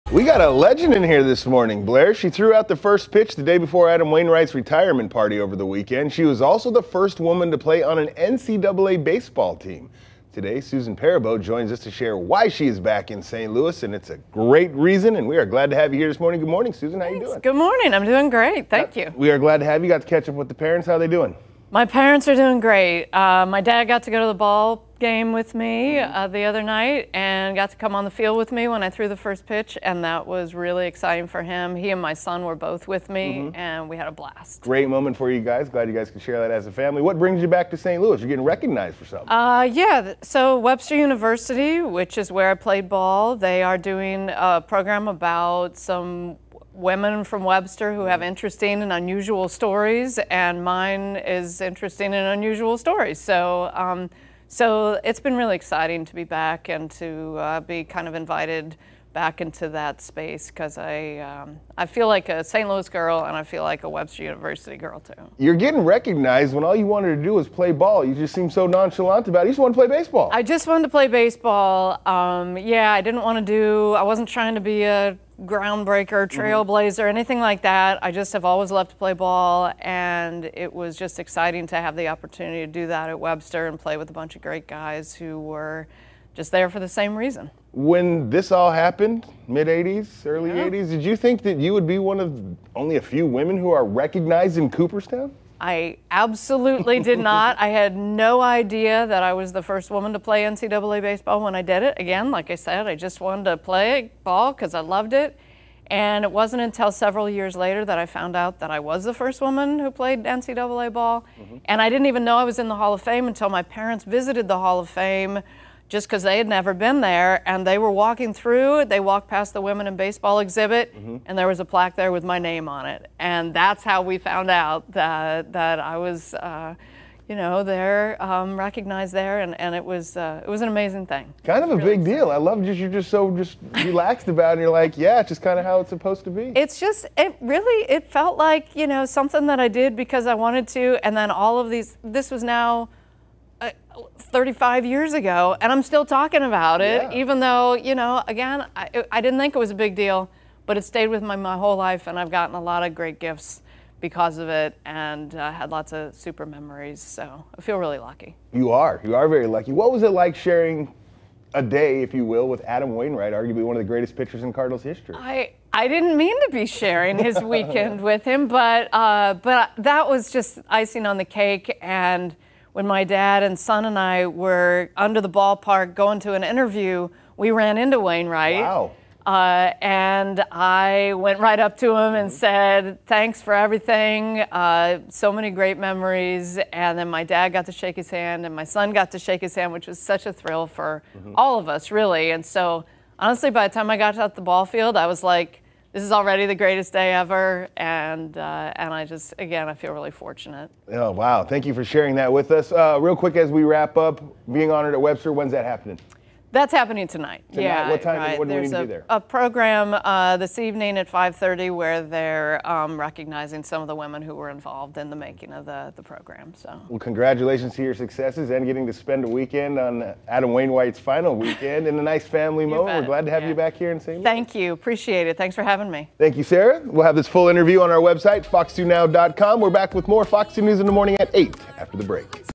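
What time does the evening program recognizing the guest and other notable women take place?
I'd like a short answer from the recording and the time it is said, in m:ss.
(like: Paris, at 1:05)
5:30, at 3:31.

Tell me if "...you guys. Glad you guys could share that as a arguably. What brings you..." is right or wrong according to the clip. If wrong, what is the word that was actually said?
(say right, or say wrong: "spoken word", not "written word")
wrong: "family", not "arguably".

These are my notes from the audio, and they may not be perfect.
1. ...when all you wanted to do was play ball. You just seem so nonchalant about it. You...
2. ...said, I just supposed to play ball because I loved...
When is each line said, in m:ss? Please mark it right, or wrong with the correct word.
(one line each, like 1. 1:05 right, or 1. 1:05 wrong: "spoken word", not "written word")
1. 1:06 right
2. 1:42 wrong: "wanted", not "supposed".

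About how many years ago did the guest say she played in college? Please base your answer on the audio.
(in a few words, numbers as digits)
35.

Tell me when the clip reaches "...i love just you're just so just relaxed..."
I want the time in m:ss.
2:12.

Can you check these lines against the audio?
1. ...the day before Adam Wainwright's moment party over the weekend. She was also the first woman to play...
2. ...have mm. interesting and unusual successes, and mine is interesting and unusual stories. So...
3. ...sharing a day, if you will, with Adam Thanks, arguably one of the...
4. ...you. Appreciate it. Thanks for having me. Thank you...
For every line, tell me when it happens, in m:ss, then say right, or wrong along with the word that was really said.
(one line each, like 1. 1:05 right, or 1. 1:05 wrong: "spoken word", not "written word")
1. 0:03 wrong: "retirement", not "moment"
2. 0:48 wrong: "stories", not "successes"
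3. 2:40 wrong: "Wainwright", not "Thanks"
4. 3:44 right.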